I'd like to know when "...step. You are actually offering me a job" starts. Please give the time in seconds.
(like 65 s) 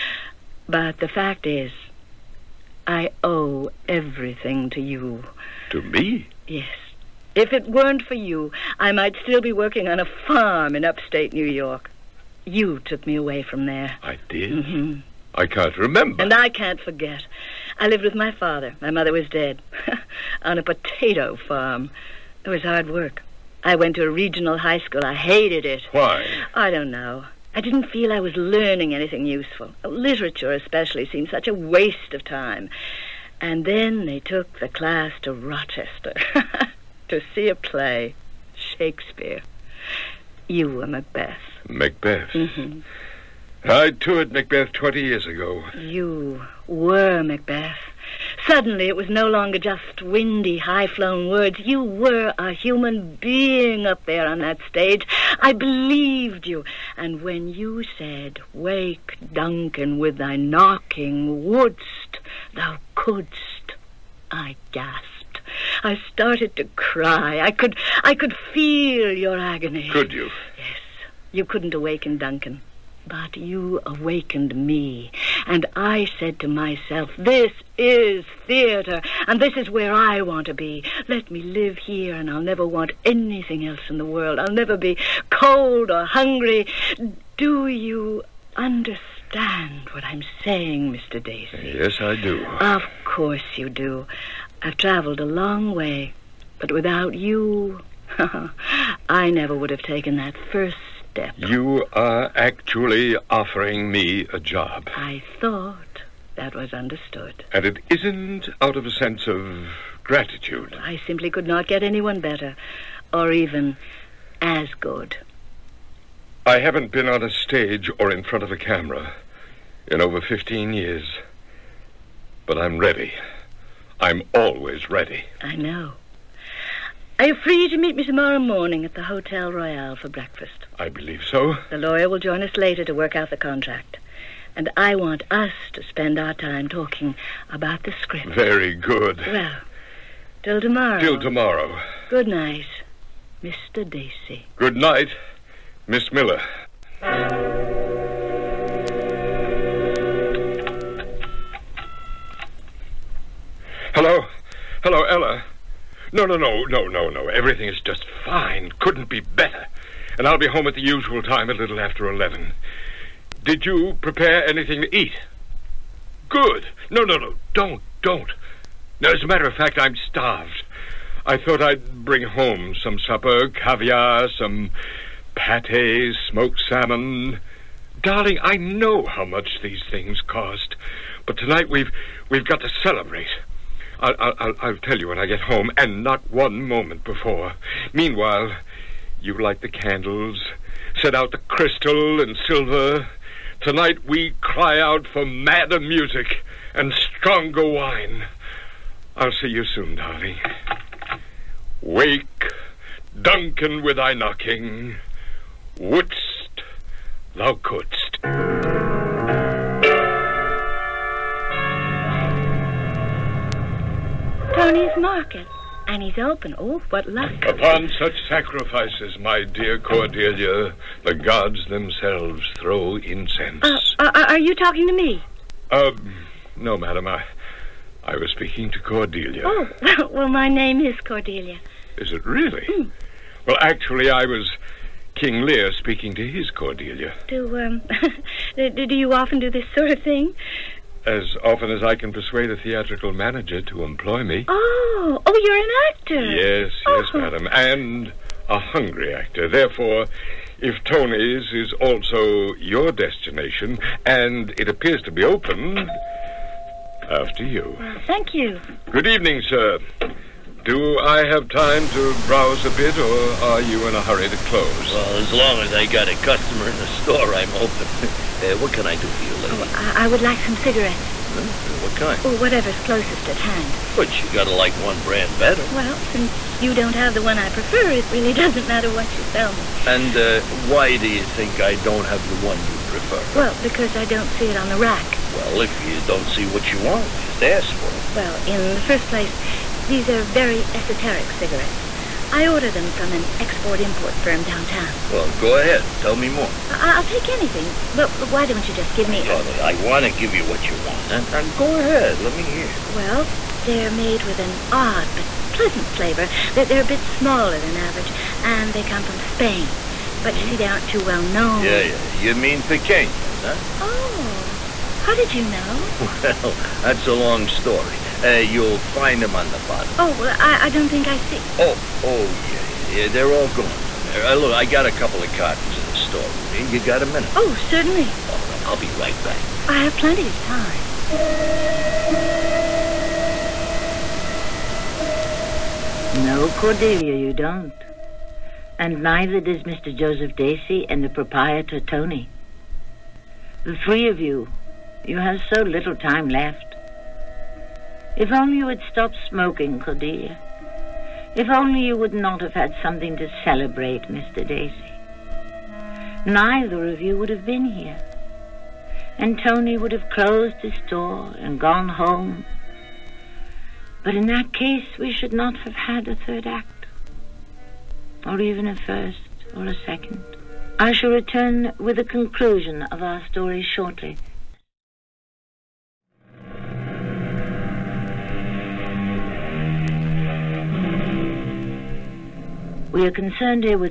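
101 s.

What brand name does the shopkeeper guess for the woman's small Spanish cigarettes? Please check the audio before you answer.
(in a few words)
pequeños.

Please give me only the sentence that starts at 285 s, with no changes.
Well, if you don't see what you want, just ask for it.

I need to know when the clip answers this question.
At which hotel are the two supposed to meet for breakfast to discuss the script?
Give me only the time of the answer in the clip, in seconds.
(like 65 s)
129 s.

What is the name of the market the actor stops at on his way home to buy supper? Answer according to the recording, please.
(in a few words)
Tony's market.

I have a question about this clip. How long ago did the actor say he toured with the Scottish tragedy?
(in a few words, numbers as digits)
20 years.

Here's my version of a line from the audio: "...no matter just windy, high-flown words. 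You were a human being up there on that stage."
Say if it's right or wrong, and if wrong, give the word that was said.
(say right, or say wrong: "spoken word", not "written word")
wrong: "longer", not "matter".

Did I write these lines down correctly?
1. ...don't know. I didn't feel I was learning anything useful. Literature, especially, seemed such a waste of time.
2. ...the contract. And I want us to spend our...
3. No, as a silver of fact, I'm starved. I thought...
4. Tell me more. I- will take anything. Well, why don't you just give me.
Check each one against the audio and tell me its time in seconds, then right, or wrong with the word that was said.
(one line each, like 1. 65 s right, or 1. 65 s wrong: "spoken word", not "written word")
1. 26 s right
2. 133 s right
3. 169 s wrong: "matter", not "silver"
4. 296 s right.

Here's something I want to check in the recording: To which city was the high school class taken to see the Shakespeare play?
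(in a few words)
Rochester.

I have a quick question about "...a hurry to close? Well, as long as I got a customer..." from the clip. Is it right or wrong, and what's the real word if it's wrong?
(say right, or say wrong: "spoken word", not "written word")
right.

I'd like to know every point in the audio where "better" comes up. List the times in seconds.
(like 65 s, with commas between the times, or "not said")
112 s, 159 s, 275 s.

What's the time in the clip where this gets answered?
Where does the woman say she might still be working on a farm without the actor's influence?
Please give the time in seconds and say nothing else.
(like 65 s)
10 s.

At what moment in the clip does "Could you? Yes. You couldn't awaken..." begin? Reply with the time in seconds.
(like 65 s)
69 s.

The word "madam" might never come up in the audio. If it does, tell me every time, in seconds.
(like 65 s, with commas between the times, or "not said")
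226 s, 247 s.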